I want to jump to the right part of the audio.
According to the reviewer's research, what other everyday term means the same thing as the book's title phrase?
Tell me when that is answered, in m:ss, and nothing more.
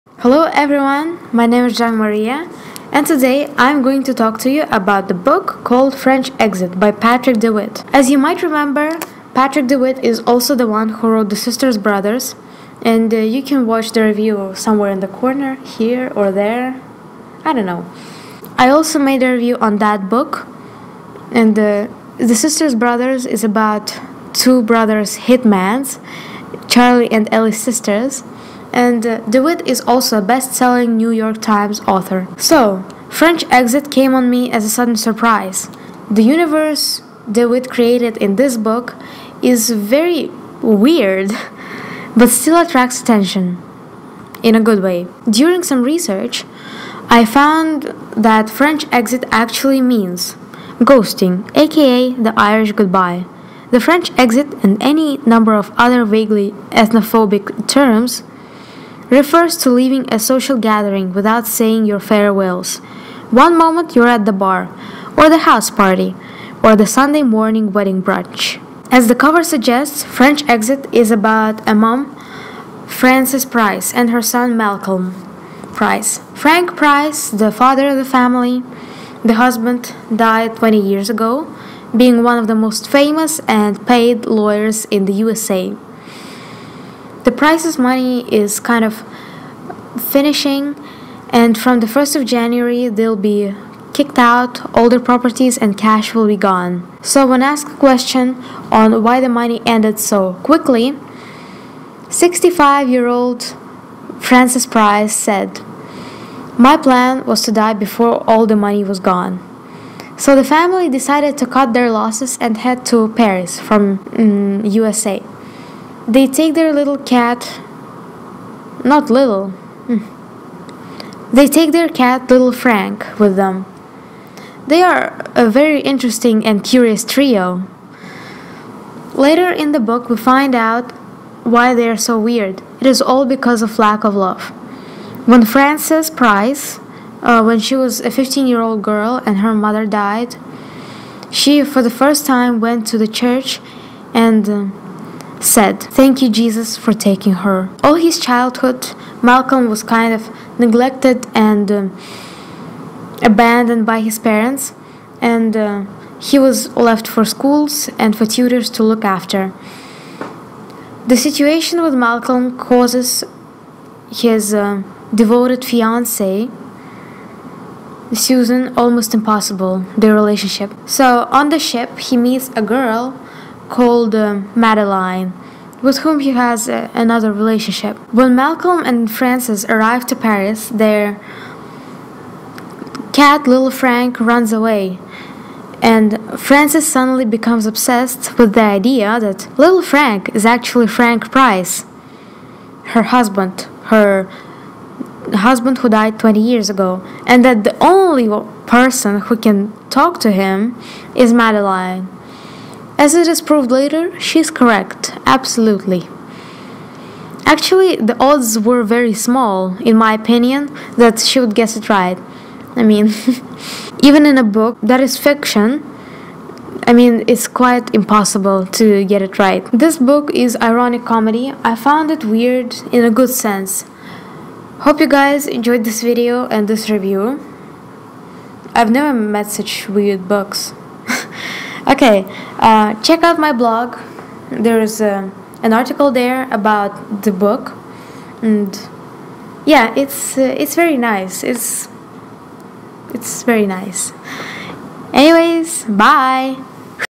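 0:50.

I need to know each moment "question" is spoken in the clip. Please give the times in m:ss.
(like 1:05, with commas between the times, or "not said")
1:37.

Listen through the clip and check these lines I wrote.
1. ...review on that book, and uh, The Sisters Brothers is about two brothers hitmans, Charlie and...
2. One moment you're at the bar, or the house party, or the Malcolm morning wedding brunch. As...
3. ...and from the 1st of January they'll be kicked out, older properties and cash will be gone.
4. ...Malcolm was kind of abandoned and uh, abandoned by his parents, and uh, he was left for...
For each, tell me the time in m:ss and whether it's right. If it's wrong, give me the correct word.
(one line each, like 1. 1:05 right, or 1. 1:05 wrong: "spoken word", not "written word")
1. 0:19 right
2. 1:03 wrong: "Sunday", not "Malcolm"
3. 1:31 right
4. 2:29 wrong: "neglected", not "abandoned".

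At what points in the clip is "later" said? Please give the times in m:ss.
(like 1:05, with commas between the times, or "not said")
2:09, 3:23.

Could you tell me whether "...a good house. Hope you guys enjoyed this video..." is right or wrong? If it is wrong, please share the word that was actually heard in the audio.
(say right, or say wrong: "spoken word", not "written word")
wrong: "sense", not "house".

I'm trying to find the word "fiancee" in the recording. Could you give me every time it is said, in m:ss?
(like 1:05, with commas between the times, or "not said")
2:45.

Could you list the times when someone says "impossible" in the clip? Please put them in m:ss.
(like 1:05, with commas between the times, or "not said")
2:49, 3:37.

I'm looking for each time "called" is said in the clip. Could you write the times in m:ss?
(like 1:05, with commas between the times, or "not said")
0:05, 2:53.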